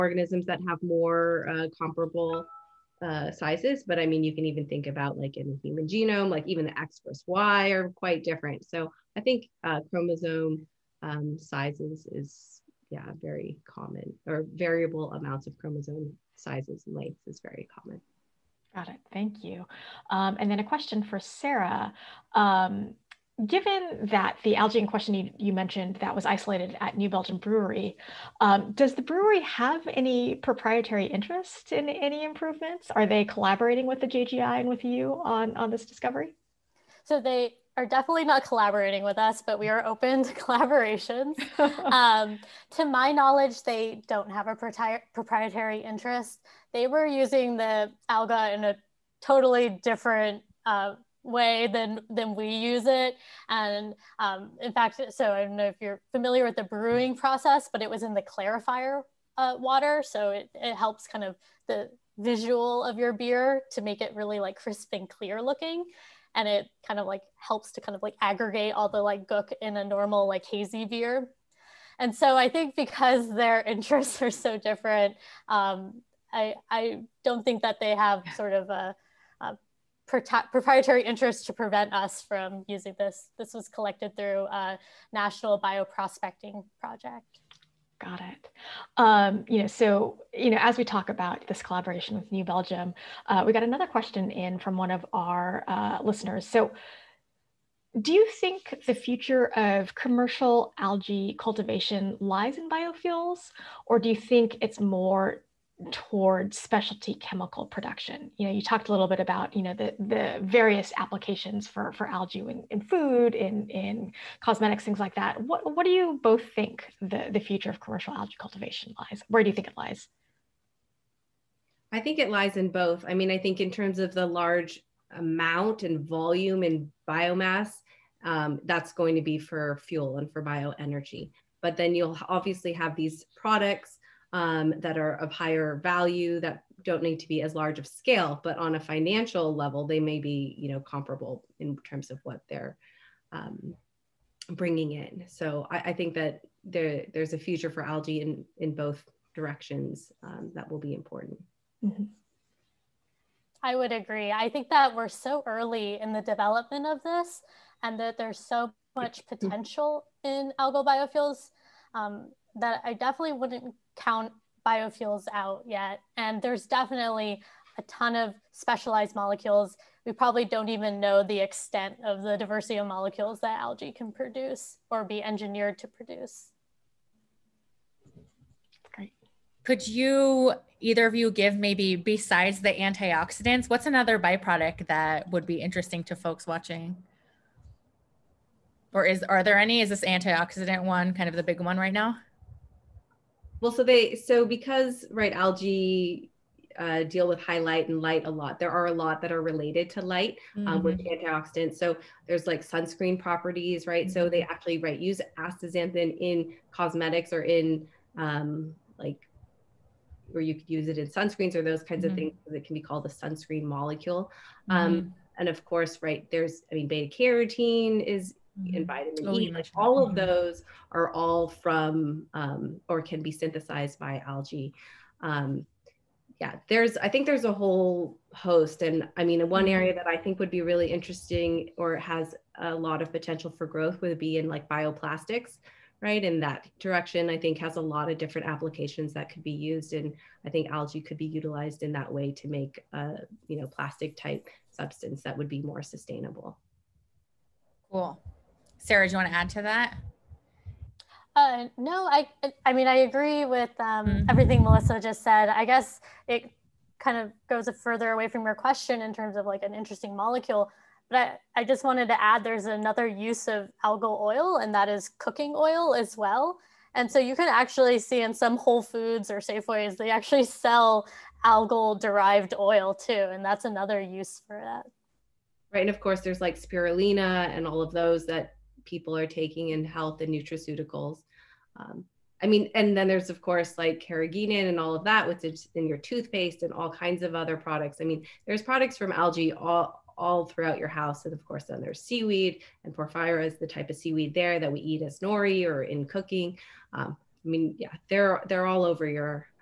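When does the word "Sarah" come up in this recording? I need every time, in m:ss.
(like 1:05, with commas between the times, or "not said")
0:21, 4:08.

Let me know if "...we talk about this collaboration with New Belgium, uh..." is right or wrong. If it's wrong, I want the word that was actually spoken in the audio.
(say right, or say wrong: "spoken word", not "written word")
right.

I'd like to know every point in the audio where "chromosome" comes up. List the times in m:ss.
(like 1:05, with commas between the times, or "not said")
0:09, 0:15.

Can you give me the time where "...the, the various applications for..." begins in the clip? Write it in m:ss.
1:49.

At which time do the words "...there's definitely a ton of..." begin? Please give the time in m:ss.
2:46.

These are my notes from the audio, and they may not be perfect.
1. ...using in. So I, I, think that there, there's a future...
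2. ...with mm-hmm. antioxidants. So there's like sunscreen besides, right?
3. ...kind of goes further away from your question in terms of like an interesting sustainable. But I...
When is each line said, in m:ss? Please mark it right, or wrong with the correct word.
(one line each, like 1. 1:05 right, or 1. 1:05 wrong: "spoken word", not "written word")
1. 2:24 wrong: "bringing", not "using"
2. 3:20 wrong: "properties", not "besides"
3. 4:16 wrong: "molecule", not "sustainable".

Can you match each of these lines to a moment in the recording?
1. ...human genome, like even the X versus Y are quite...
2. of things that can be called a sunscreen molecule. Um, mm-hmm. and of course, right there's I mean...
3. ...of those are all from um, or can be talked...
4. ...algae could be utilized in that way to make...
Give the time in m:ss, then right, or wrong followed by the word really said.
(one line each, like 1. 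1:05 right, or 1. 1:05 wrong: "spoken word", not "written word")
1. 0:05 right
2. 3:32 right
3. 3:40 wrong: "synthesized", not "talked"
4. 4:00 right.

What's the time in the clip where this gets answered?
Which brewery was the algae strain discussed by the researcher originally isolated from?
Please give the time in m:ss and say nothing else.
0:26.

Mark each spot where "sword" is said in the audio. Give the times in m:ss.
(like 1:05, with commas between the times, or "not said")
not said.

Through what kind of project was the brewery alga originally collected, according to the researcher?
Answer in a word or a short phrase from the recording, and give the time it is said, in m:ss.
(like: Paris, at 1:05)
National Bioprospecting Project, at 1:25.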